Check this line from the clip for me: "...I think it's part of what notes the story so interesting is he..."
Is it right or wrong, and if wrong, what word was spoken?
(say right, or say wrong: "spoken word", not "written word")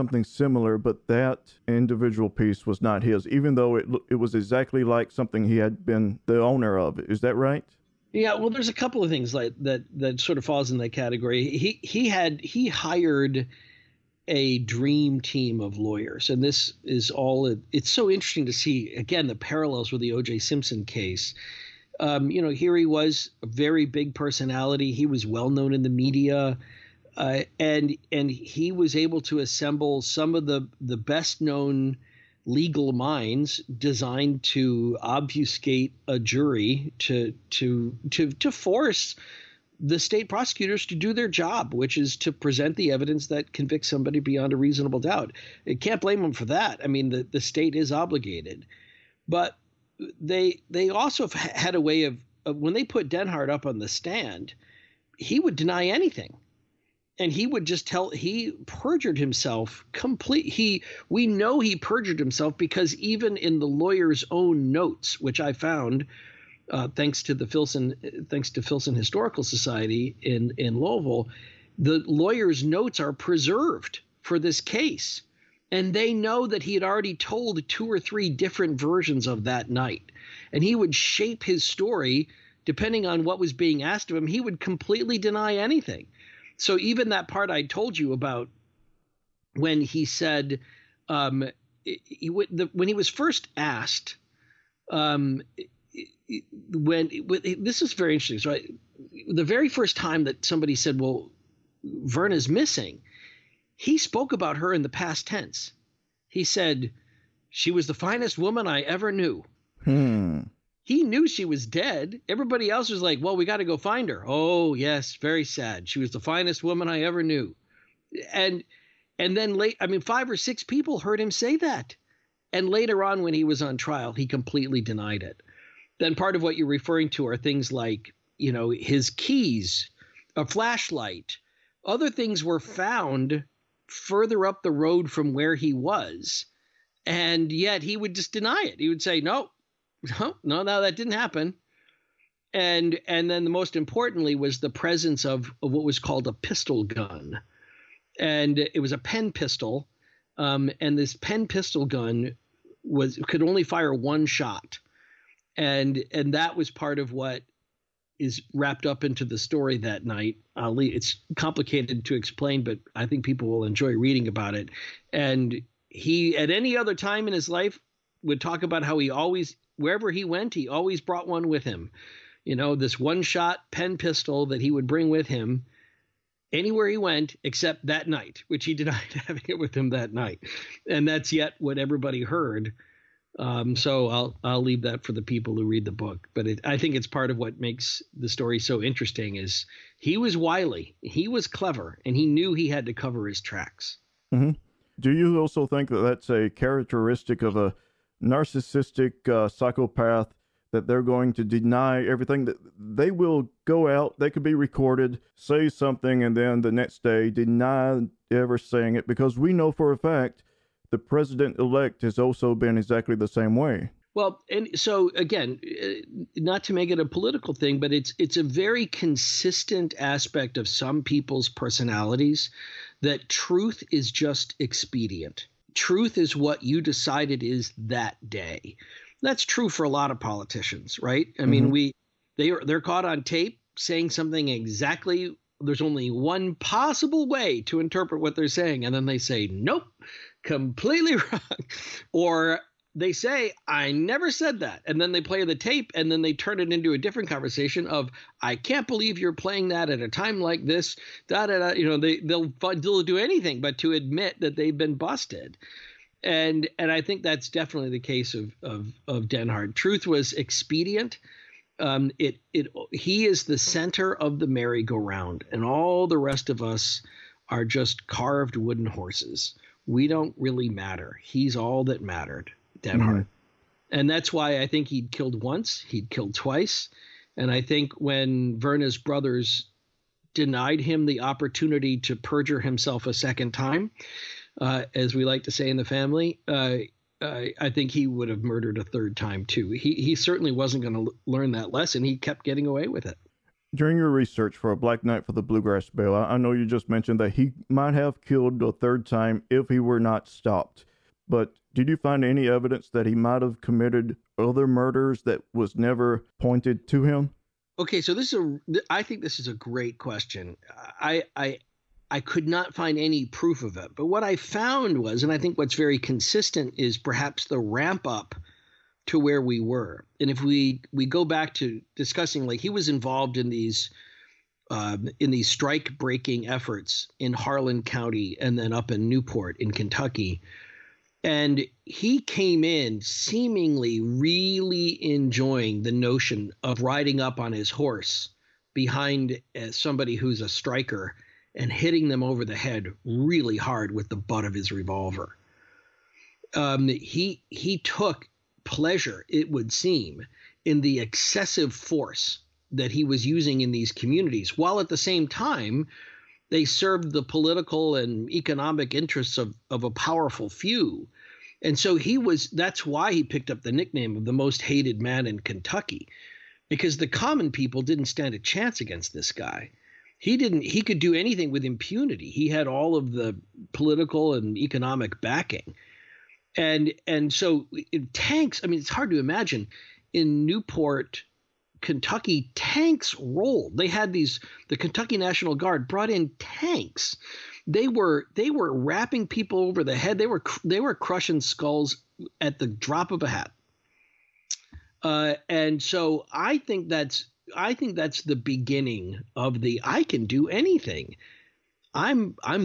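wrong: "makes", not "notes".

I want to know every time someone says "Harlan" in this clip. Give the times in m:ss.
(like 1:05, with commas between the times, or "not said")
5:27.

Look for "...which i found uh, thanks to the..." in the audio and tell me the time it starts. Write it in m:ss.
1:05.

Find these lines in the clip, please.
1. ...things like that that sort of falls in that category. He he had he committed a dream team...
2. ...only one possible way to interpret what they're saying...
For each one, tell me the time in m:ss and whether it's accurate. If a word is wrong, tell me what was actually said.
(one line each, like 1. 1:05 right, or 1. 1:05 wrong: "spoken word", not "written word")
1. 0:09 wrong: "hired", not "committed"
2. 3:55 right.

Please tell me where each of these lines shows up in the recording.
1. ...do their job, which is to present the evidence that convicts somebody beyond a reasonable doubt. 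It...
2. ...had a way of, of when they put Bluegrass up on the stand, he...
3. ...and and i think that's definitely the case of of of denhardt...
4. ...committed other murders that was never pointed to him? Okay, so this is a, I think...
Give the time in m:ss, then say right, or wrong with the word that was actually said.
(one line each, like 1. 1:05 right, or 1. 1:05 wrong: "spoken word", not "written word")
1. 0:40 right
2. 0:51 wrong: "Denhardt", not "Bluegrass"
3. 4:16 right
4. 5:03 right.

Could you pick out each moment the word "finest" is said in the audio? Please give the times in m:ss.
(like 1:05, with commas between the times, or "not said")
1:47, 1:56.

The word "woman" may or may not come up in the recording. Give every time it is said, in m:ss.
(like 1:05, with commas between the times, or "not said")
1:48, 1:56.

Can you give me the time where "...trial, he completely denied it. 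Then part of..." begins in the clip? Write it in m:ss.
2:03.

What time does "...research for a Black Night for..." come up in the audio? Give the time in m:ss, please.
4:54.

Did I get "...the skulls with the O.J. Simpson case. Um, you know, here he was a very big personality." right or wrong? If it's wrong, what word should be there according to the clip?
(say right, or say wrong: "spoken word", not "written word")
wrong: "parallels", not "skulls".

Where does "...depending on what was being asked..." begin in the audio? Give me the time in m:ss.
1:22.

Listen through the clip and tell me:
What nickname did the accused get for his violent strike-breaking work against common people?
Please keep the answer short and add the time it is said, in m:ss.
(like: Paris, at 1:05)
The most hated man in Kentucky, at 6:04.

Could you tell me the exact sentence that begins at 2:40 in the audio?
Ali, it's complicated to explain, but I think people will enjoy reading about it.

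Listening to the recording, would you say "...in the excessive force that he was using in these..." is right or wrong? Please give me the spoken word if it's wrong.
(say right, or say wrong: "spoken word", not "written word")
right.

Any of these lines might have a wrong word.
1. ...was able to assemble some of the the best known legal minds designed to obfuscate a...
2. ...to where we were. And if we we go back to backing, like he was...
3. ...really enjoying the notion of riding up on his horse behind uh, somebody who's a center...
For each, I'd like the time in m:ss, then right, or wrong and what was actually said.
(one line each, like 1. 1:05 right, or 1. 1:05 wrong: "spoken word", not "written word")
1. 0:28 right
2. 5:19 wrong: "discussing", not "backing"
3. 5:33 wrong: "striker", not "center".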